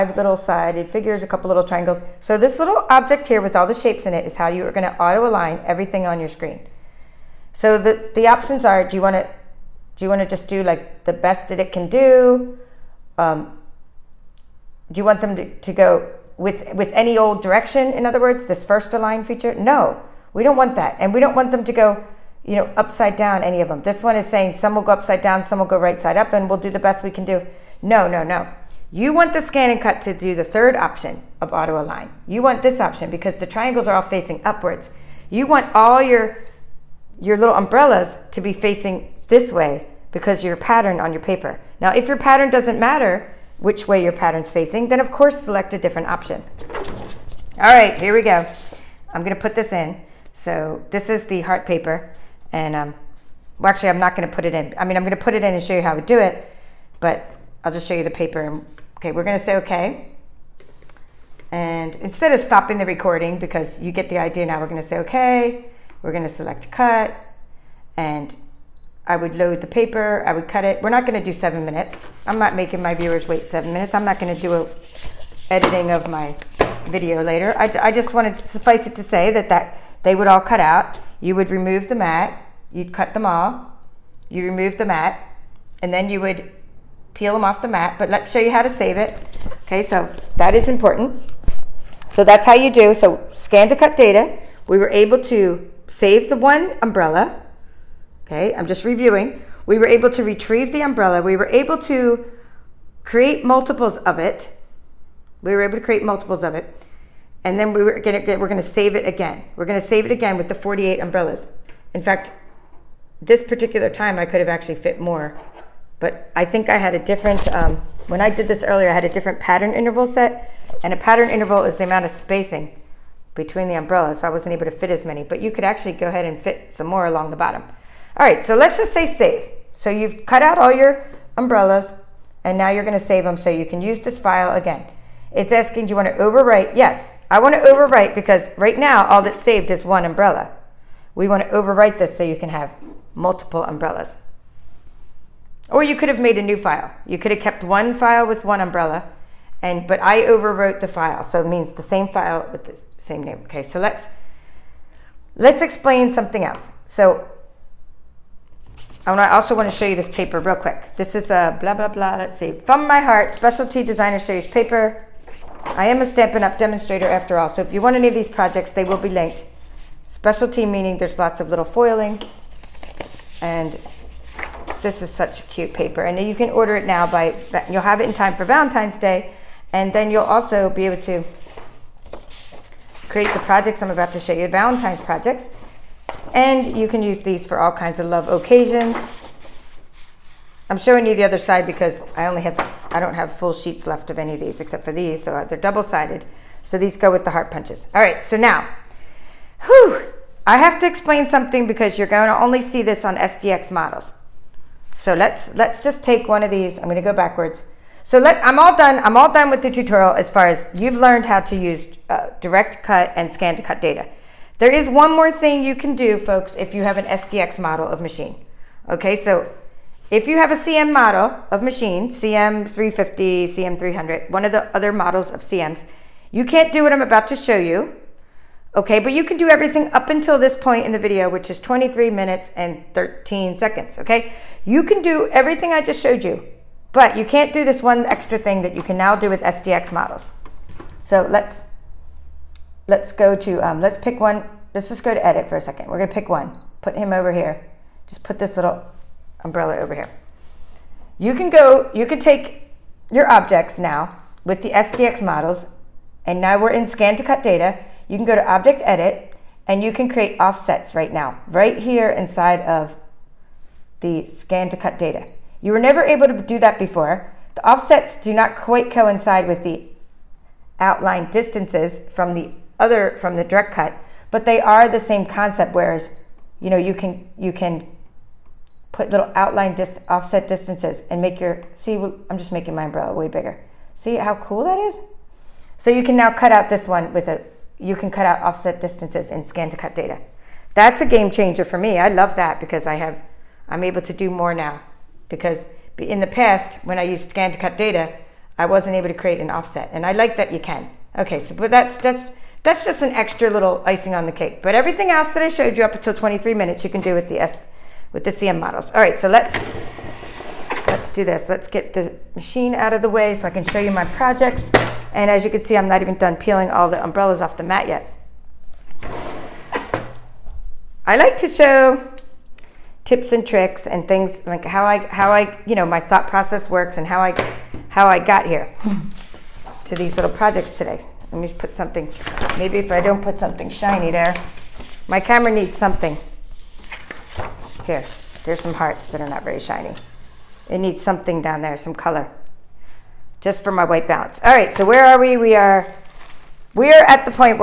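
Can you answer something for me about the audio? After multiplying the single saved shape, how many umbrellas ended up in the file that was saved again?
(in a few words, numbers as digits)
48.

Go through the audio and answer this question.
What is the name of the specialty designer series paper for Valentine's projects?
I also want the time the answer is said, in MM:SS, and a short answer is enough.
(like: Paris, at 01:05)
From My Heart, at 02:42.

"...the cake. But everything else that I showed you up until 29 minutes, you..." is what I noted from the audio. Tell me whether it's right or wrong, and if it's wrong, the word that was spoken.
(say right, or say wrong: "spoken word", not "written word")
wrong: "23", not "29".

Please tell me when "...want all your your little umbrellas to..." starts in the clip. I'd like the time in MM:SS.
00:35.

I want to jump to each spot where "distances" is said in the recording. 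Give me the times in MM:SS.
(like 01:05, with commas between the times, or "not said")
04:31, 04:40, 04:48.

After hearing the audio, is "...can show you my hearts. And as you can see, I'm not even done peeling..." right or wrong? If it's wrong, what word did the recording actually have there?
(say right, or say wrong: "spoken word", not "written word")
wrong: "projects", not "hearts".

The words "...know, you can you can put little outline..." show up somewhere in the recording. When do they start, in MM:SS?
04:36.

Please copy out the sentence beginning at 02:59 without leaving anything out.
And then you'll also be able to create the projects I'm about to show you, Valentine's projects.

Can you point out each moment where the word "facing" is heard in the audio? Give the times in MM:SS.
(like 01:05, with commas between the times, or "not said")
00:34, 00:38, 00:44.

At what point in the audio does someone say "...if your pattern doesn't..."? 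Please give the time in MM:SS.
00:41.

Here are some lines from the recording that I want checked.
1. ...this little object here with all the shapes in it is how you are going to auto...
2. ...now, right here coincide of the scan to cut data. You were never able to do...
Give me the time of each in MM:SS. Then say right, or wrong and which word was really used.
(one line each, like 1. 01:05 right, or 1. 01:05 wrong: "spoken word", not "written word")
1. 00:02 right
2. 04:21 wrong: "inside", not "coincide".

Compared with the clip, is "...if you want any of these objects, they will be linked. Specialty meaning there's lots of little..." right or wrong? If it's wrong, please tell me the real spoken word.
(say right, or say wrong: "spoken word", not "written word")
wrong: "projects", not "objects".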